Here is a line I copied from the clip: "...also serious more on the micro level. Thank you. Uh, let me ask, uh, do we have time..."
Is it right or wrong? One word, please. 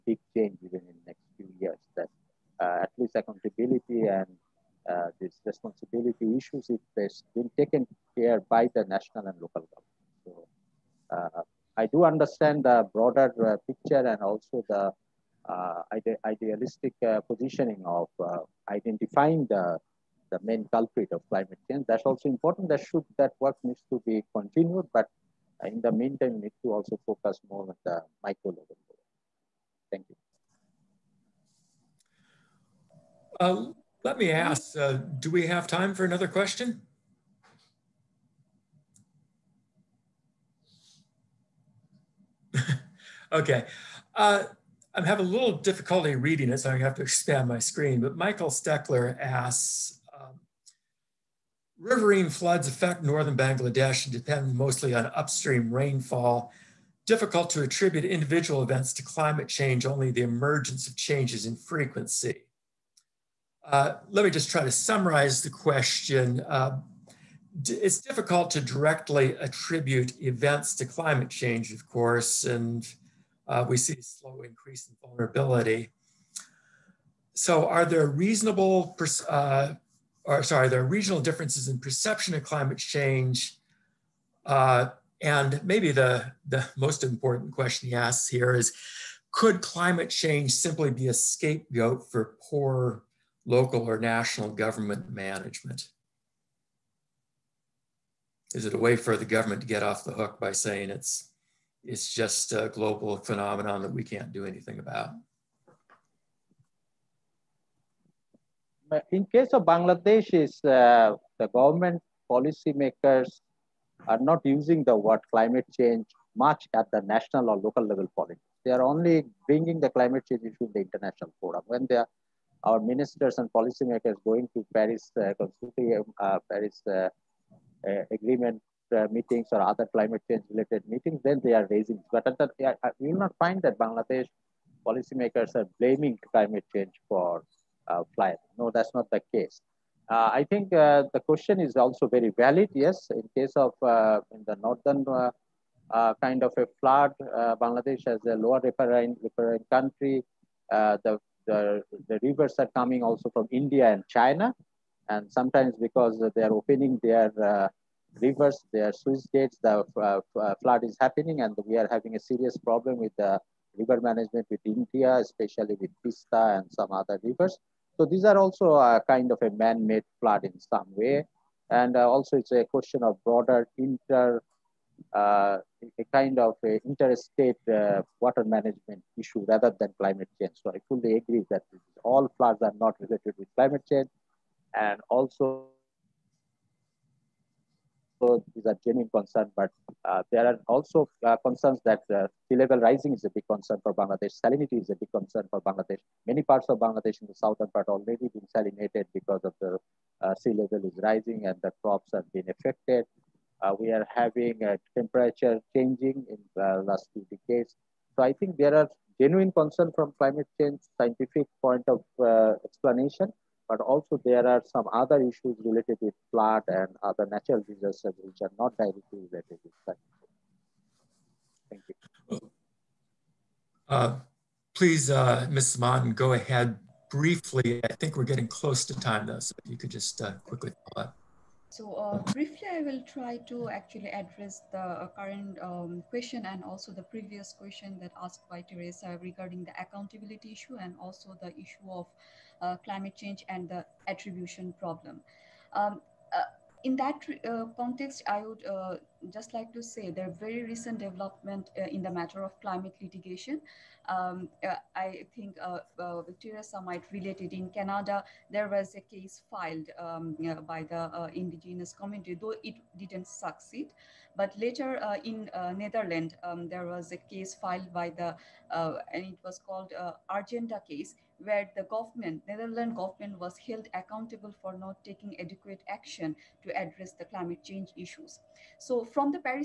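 wrong.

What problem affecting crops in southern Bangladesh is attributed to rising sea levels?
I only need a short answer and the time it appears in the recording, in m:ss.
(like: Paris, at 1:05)
Salinity, at 3:14.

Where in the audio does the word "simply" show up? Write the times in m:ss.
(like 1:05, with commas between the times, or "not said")
1:30.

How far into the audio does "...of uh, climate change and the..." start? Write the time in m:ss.
4:01.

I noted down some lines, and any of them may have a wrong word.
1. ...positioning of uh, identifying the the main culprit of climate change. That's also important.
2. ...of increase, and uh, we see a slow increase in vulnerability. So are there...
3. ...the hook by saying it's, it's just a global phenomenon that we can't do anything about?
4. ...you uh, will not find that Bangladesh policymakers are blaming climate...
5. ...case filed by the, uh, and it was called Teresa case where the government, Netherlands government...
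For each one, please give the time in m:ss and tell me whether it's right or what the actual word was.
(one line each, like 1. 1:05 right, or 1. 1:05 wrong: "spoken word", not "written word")
1. 0:17 right
2. 1:11 wrong: "course", not "increase"
3. 1:40 right
4. 2:12 right
5. 4:27 wrong: "Urgenda", not "Teresa".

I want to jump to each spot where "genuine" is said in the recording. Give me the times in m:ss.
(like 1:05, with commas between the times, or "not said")
3:08, 3:29.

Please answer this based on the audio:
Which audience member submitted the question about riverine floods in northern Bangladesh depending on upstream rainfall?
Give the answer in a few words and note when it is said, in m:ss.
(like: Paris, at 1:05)
Michael Steckler, at 0:48.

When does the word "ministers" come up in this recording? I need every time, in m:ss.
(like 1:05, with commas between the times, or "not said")
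2:02.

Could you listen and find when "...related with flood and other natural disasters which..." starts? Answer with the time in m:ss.
3:35.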